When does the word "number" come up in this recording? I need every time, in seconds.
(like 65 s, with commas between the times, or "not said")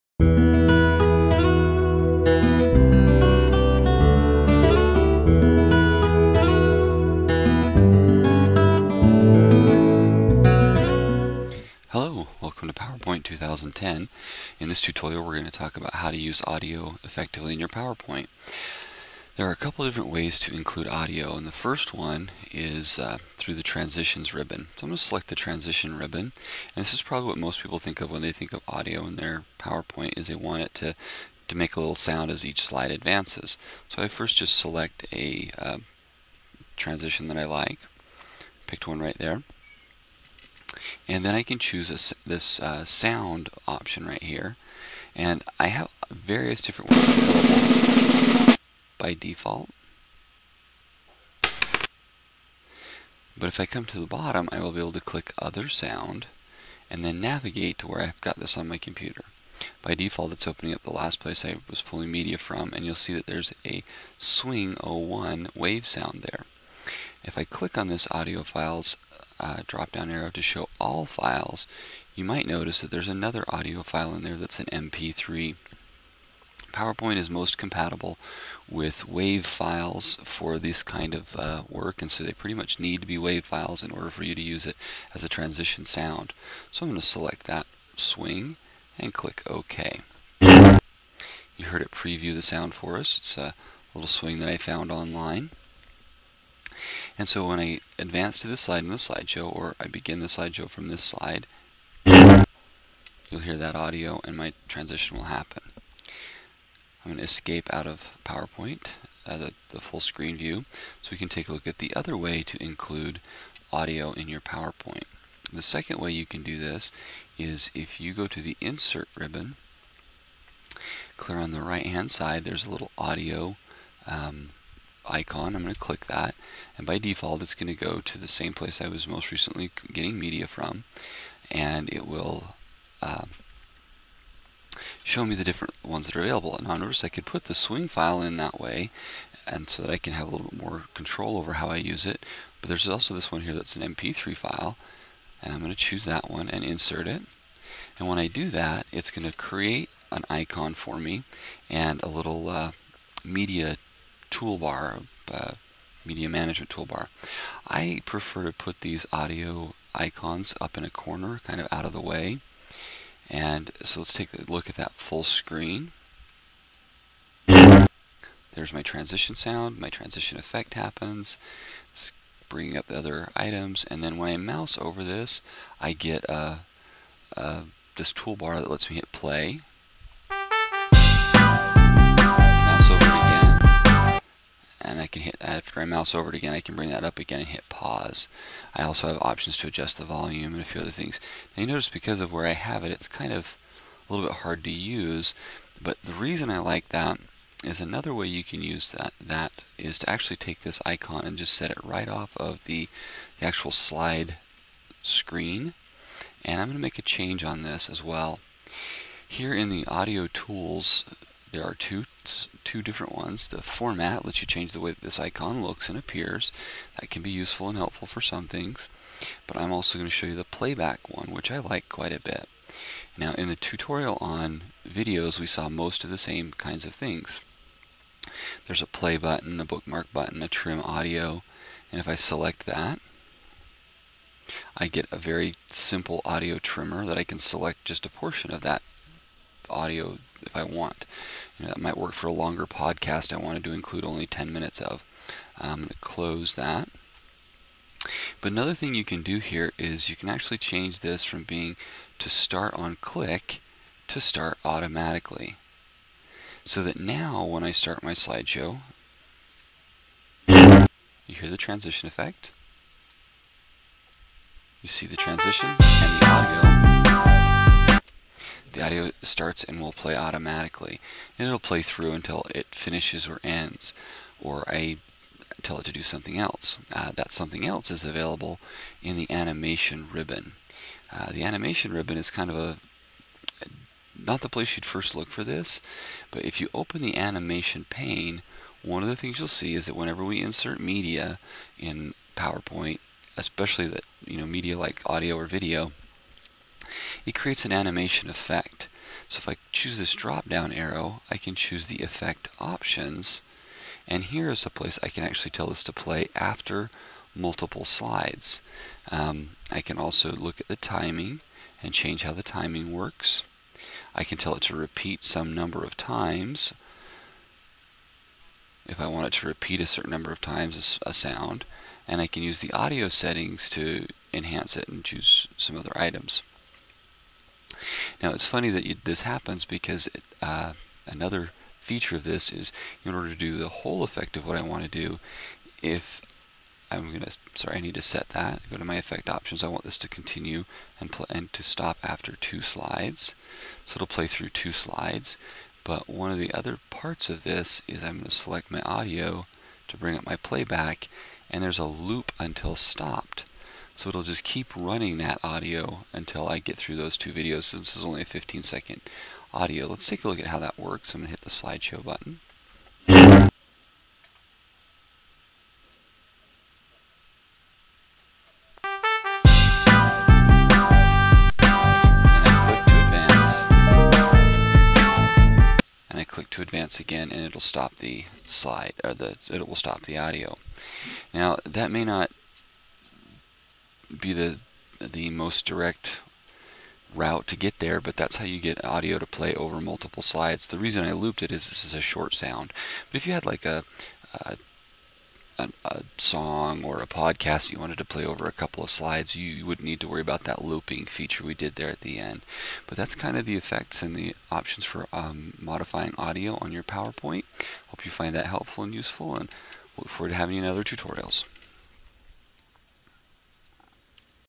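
315 s, 320 s.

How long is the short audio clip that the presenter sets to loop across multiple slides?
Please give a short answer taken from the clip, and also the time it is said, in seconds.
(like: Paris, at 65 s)
15 seconds, at 358 s.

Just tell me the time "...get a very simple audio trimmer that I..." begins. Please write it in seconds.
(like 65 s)
234 s.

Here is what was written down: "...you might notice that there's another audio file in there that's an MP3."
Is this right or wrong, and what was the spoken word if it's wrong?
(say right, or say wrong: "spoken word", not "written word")
right.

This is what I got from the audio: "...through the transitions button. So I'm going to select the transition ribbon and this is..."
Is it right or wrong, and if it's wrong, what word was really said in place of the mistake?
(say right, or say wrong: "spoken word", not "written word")
wrong: "ribbon", not "button".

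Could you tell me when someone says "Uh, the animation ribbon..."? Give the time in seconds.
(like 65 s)
281 s.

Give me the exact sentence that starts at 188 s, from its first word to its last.
I also have options to adjust the volume and a few other things.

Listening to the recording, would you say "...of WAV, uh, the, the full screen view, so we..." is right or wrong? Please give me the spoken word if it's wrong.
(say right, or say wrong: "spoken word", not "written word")
wrong: "PowerPoint", not "WAV".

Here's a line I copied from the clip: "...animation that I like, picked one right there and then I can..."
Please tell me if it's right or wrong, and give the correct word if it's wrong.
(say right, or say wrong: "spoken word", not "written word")
wrong: "transition", not "animation".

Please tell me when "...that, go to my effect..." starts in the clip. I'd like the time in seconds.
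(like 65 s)
338 s.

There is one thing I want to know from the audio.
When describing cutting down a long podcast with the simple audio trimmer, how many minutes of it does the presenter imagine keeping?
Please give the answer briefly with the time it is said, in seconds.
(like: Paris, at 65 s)
10 minutes, at 244 s.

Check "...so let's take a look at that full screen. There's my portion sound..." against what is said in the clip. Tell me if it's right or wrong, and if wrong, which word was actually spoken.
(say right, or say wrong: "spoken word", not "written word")
wrong: "transition", not "portion".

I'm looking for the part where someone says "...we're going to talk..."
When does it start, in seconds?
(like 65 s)
15 s.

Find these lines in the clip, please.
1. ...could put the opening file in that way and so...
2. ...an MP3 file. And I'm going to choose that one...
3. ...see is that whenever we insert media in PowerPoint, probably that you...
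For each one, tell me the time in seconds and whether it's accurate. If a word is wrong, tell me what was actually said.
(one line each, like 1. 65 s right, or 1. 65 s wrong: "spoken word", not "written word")
1. 137 s wrong: "swing", not "opening"
2. 143 s right
3. 289 s wrong: "especially", not "probably".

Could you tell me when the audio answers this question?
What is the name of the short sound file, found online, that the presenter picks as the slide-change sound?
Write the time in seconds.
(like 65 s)
64 s.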